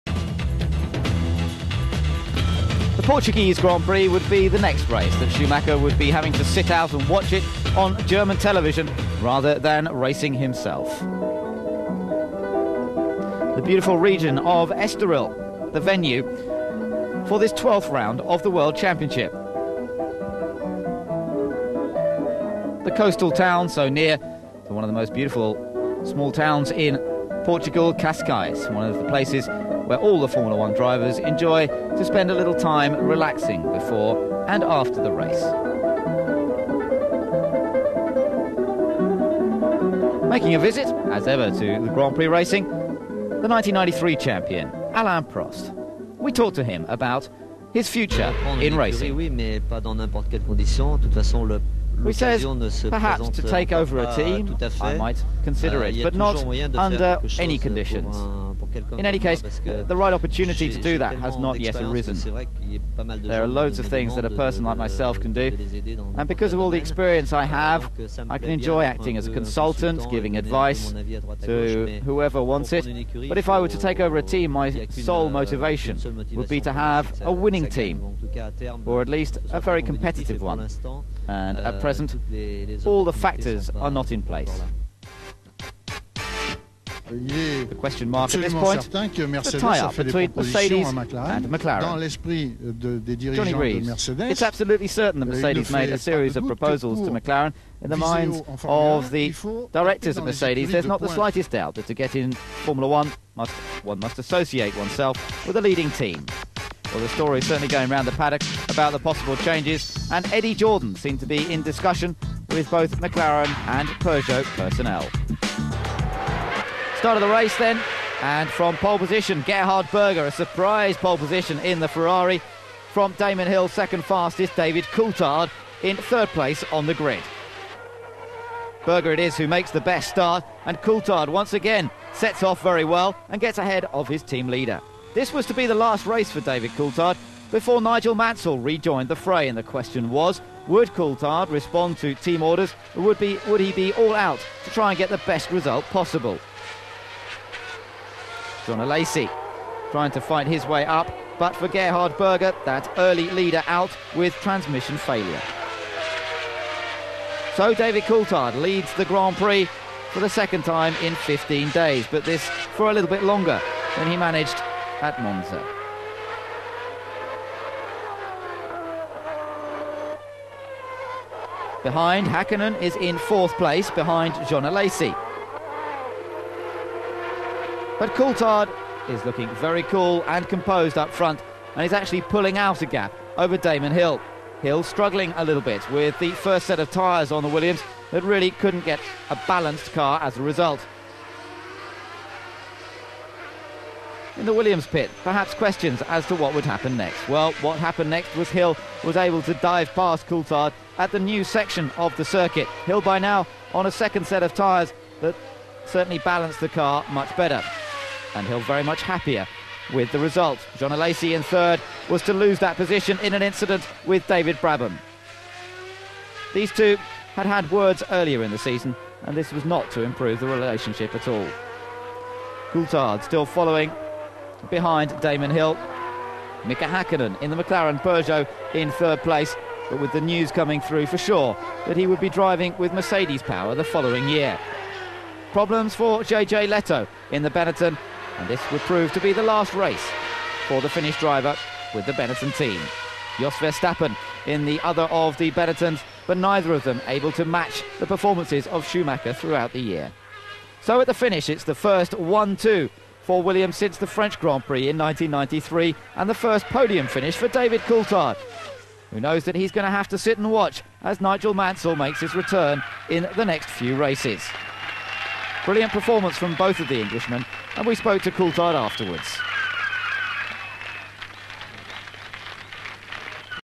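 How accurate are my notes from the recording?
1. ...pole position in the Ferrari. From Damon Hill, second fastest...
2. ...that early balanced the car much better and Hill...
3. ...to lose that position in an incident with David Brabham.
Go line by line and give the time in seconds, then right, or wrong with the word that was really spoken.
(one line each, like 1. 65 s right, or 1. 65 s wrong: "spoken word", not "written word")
1. 120 s right
2. 205 s wrong: "certainly", not "early"
3. 212 s right.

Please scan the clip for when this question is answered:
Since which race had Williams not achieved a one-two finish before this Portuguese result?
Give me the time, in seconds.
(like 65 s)
254 s.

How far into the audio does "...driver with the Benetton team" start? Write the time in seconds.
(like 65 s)
241 s.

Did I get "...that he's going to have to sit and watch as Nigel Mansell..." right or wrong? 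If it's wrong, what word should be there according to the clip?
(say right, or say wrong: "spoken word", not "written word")
right.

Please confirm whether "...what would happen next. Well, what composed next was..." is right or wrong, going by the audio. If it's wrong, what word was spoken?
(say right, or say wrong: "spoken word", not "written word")
wrong: "happened", not "composed".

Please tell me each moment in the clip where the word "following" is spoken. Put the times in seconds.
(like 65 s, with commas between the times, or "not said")
223 s, 233 s.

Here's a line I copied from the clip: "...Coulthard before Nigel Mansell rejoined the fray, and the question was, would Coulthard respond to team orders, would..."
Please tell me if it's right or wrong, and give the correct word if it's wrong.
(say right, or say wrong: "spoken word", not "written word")
right.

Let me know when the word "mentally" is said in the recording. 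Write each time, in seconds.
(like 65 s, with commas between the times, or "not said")
not said.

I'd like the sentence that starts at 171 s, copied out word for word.
Behind, Hakkinen is in fourth place behind Jean Alesi.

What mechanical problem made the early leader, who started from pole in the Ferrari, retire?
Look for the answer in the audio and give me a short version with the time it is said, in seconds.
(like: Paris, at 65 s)
transmission failure, at 154 s.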